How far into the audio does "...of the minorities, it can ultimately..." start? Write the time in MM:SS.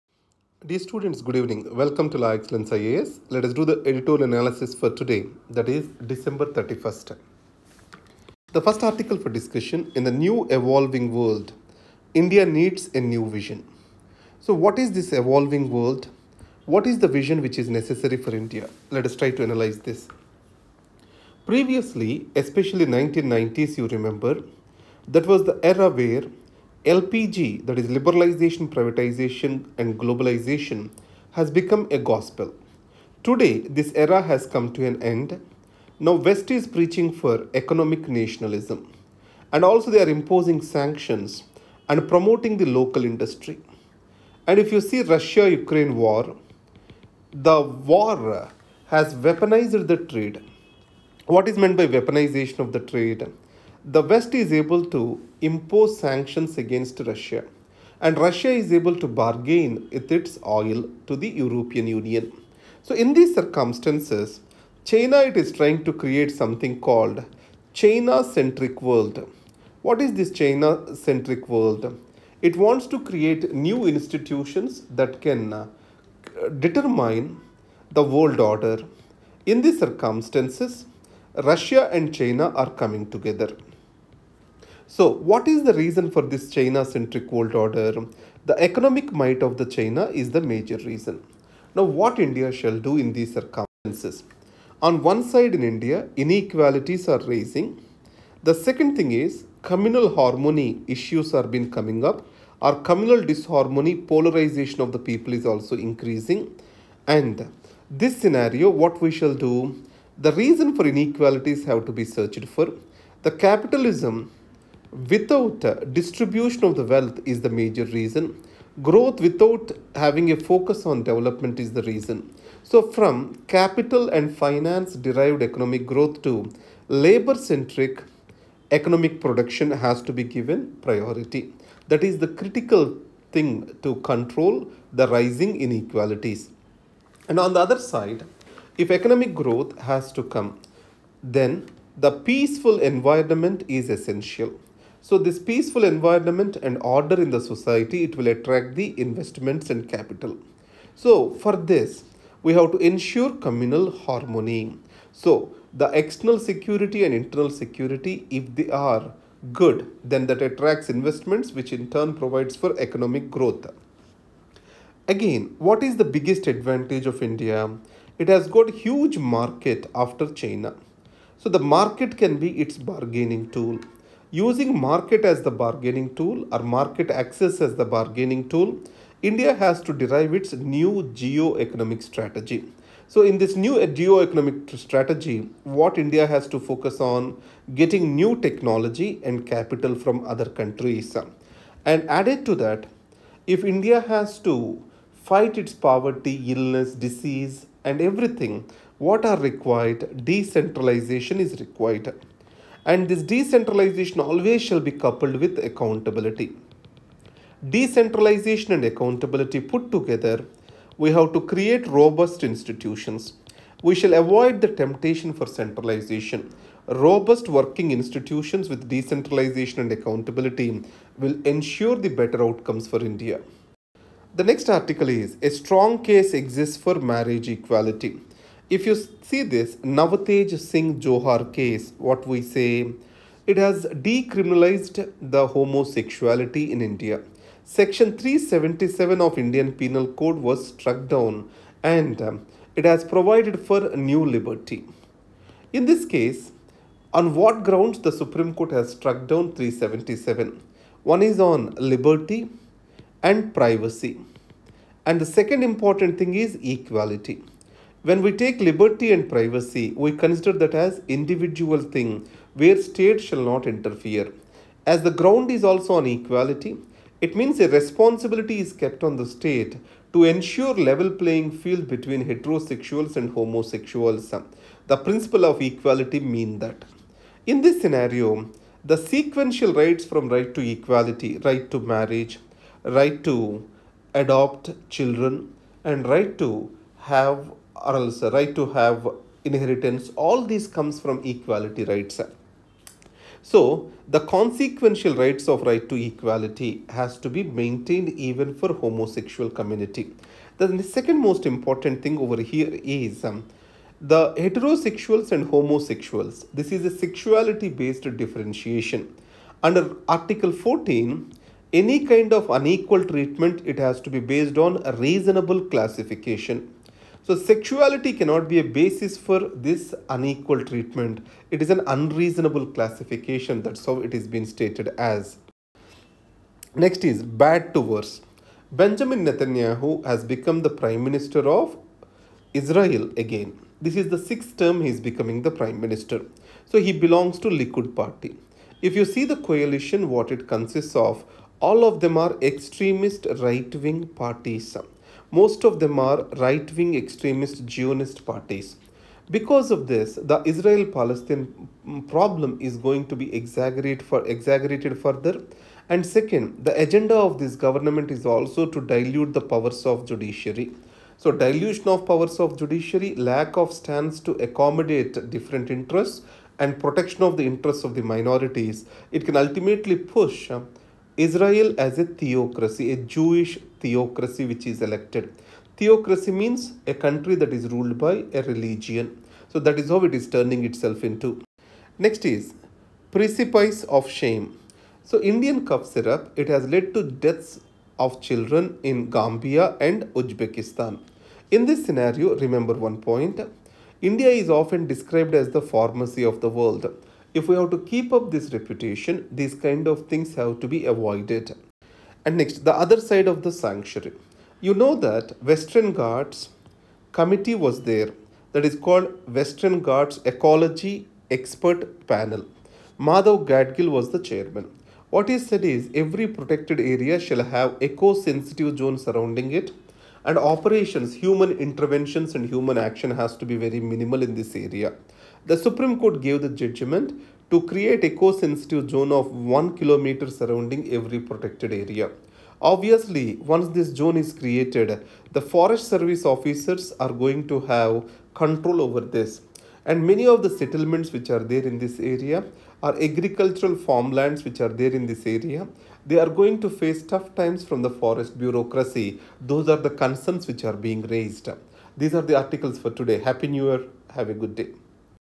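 06:07.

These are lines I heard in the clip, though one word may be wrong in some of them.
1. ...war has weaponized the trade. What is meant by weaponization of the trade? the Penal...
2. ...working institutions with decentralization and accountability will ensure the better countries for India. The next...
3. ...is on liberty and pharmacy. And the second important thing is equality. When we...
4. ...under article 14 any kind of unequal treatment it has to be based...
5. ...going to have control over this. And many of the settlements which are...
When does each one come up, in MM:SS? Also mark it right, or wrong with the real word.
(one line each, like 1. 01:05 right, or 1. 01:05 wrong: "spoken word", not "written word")
1. 00:47 wrong: "West", not "Penal"
2. 03:37 wrong: "outcomes", not "countries"
3. 04:11 wrong: "privacy", not "pharmacy"
4. 05:09 right
5. 07:17 right.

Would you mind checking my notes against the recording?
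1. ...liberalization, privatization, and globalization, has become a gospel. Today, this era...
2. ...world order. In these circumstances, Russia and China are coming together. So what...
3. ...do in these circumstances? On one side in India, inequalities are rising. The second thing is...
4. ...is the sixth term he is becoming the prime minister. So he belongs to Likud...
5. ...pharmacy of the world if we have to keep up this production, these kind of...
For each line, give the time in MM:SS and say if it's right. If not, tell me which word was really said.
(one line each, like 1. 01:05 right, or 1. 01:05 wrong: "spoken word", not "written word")
1. 00:27 right
2. 01:18 right
3. 01:32 right
4. 05:33 right
5. 06:35 wrong: "reputation", not "production".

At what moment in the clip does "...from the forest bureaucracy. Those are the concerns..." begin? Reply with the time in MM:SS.
07:27.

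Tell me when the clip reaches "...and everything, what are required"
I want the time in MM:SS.
03:17.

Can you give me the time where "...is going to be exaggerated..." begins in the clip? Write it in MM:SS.
05:52.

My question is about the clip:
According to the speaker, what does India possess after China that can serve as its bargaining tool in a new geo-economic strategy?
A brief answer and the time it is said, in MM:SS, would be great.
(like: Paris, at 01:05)
Huge market, at 02:48.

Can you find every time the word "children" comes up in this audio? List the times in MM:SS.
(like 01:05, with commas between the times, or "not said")
04:44, 06:28.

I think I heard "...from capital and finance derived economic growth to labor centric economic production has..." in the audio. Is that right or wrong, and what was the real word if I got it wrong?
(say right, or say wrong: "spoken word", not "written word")
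right.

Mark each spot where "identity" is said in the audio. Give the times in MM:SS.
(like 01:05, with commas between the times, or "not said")
not said.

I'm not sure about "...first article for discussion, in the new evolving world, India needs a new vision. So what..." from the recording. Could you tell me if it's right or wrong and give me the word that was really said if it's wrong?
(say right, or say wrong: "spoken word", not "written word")
right.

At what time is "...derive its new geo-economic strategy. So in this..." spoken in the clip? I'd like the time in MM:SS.
02:59.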